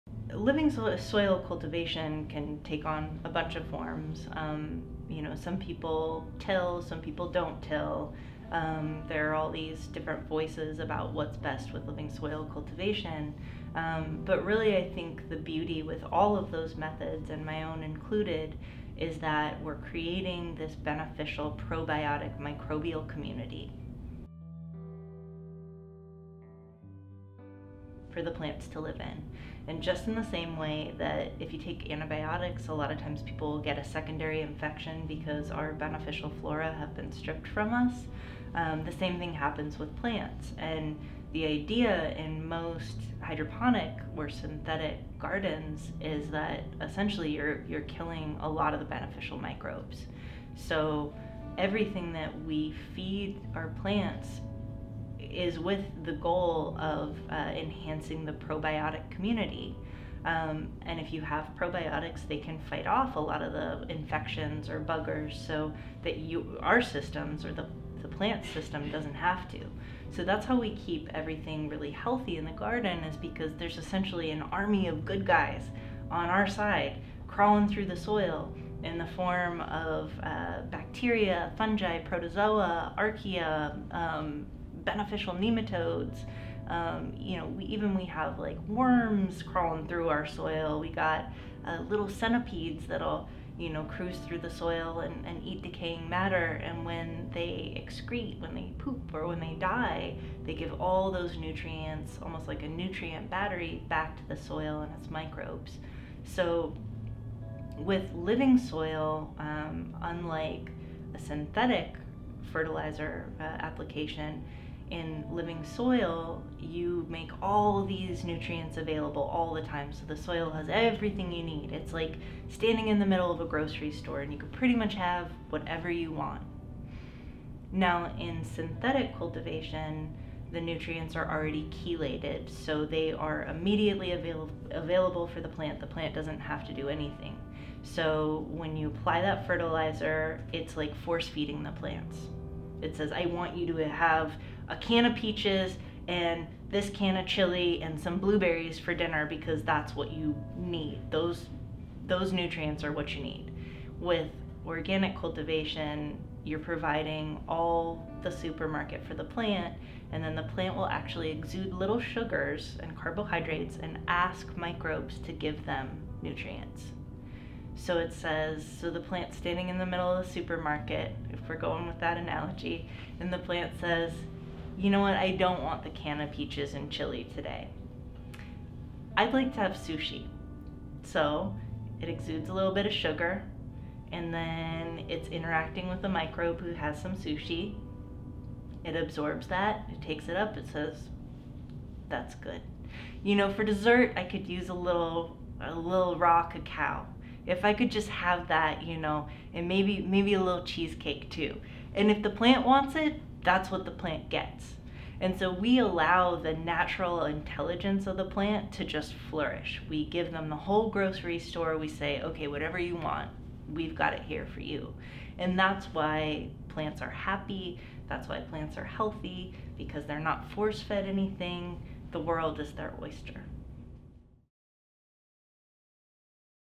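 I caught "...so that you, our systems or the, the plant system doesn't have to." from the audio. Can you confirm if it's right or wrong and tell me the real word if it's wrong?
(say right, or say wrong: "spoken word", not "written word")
right.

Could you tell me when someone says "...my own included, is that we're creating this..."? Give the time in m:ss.
0:17.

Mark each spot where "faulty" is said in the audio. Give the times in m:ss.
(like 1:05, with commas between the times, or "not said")
not said.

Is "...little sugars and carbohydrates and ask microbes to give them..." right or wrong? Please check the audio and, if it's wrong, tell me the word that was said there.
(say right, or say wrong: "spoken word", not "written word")
right.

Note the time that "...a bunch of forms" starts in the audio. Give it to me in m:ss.
0:03.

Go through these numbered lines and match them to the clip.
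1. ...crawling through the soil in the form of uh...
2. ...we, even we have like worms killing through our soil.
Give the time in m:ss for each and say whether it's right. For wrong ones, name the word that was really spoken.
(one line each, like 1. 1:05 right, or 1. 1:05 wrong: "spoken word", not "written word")
1. 1:17 right
2. 1:27 wrong: "crawling", not "killing".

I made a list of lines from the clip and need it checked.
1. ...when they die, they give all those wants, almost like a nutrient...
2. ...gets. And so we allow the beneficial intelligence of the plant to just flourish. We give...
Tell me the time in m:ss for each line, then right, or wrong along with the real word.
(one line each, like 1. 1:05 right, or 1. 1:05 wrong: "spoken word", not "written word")
1. 1:39 wrong: "nutrients", not "wants"
2. 3:24 wrong: "natural", not "beneficial".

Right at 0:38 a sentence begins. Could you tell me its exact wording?
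Um, the same thing happens with plants.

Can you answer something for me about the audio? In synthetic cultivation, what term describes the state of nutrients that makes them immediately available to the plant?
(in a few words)
chelated.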